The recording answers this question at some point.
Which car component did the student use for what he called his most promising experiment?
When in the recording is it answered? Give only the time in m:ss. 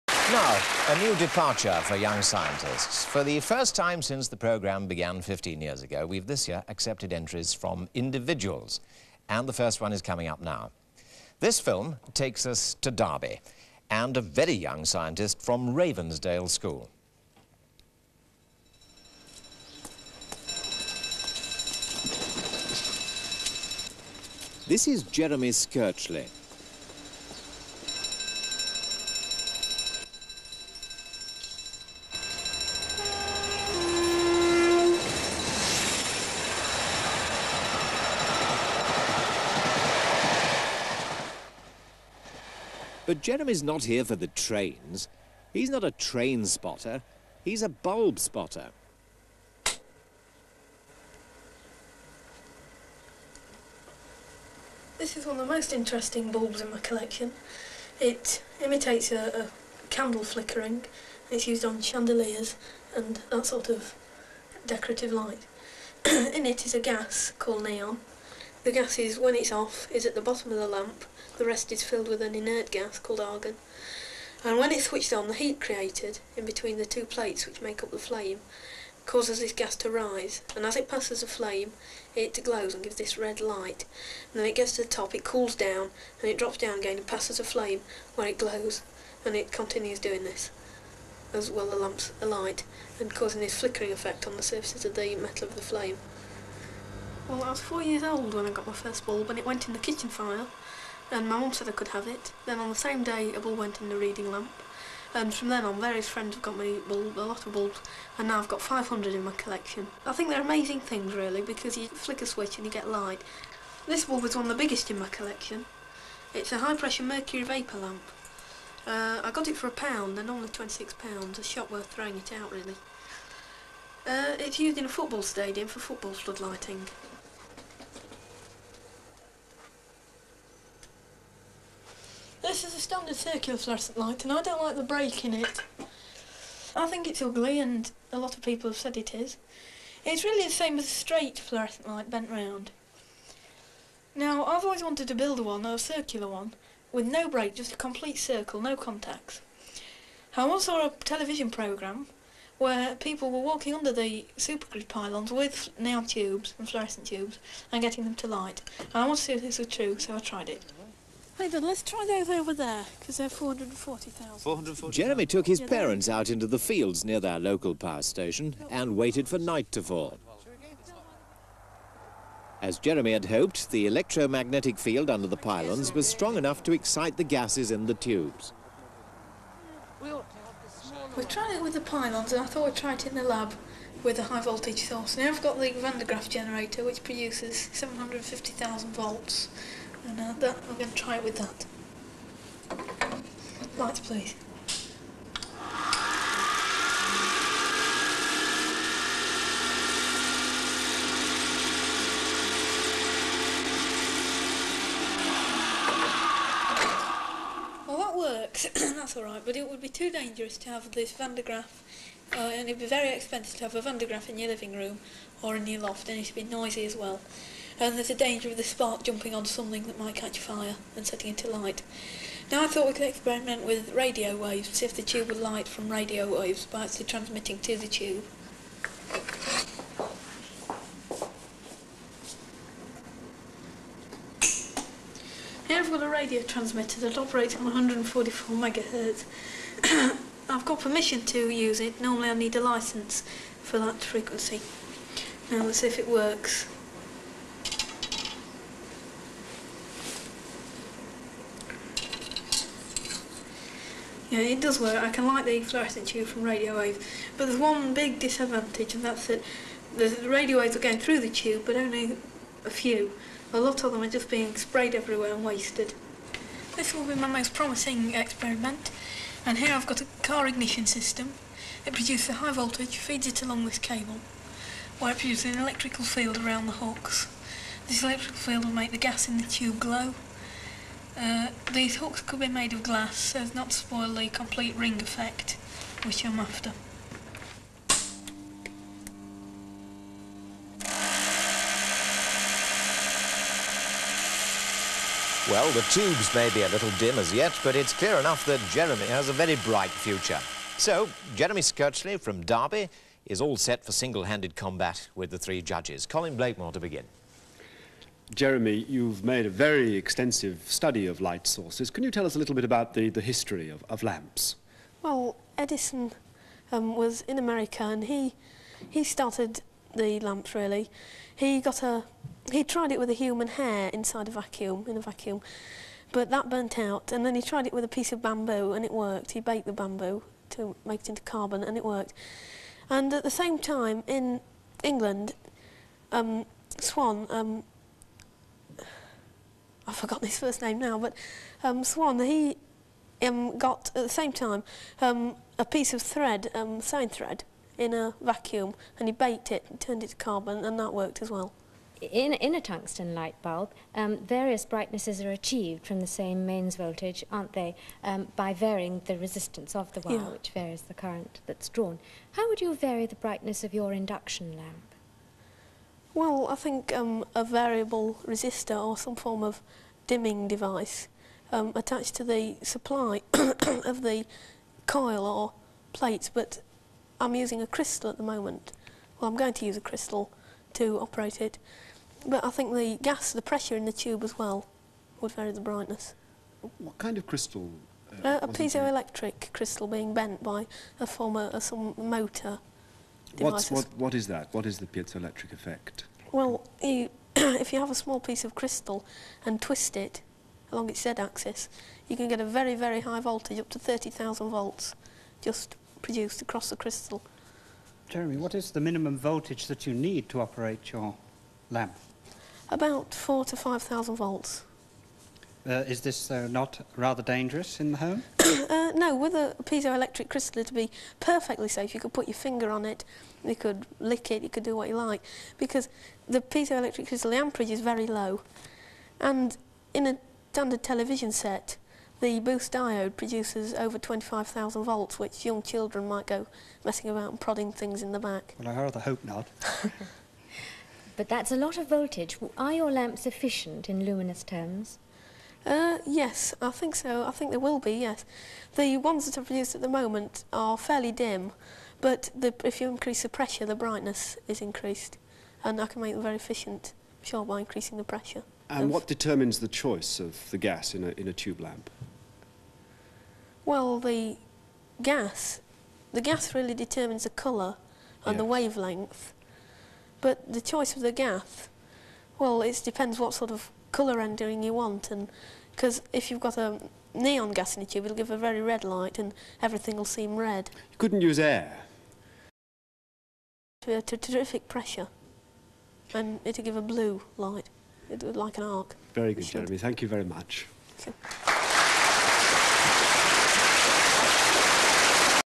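4:30.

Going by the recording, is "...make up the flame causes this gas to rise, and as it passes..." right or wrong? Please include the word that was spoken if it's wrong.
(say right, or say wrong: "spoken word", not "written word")
right.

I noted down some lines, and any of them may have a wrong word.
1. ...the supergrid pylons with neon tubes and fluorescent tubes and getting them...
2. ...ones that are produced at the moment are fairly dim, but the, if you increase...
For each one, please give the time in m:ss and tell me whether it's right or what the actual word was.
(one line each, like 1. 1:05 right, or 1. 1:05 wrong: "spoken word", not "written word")
1. 2:33 right
2. 7:28 right.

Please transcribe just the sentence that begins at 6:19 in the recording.
Well, I'm going to use a crystal to operate it.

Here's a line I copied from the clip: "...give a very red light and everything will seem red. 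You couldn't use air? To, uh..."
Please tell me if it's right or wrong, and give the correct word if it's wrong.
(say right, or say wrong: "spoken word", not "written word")
right.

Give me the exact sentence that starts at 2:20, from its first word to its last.
It's really the same as a straight fluorescent light bent round.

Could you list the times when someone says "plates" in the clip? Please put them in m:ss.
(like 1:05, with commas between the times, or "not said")
1:17, 6:15.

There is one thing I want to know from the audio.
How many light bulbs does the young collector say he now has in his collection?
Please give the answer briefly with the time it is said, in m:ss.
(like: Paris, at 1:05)
500, at 1:48.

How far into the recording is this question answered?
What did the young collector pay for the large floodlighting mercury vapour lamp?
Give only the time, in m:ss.
1:59.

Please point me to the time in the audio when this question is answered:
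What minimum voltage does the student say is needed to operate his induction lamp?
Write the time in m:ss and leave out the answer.
6:53.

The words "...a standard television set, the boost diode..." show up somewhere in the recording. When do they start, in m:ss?
7:10.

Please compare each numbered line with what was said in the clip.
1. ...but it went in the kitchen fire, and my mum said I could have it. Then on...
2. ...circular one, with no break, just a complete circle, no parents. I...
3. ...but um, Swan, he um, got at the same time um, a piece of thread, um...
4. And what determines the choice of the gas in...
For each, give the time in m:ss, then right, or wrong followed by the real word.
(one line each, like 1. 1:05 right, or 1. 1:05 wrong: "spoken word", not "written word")
1. 1:39 right
2. 2:25 wrong: "contacts", not "parents"
3. 5:40 right
4. 7:38 right.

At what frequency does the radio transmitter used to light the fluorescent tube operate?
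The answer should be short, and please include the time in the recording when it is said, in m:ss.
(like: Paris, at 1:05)
144 megahertz, at 3:57.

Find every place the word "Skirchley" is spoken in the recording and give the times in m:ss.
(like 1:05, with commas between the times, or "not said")
0:25, 5:01.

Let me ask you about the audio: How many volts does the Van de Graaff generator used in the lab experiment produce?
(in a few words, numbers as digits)
750,000.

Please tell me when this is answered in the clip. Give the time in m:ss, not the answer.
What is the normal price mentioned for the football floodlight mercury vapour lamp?
2:00.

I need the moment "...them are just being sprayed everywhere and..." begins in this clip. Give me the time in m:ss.
4:23.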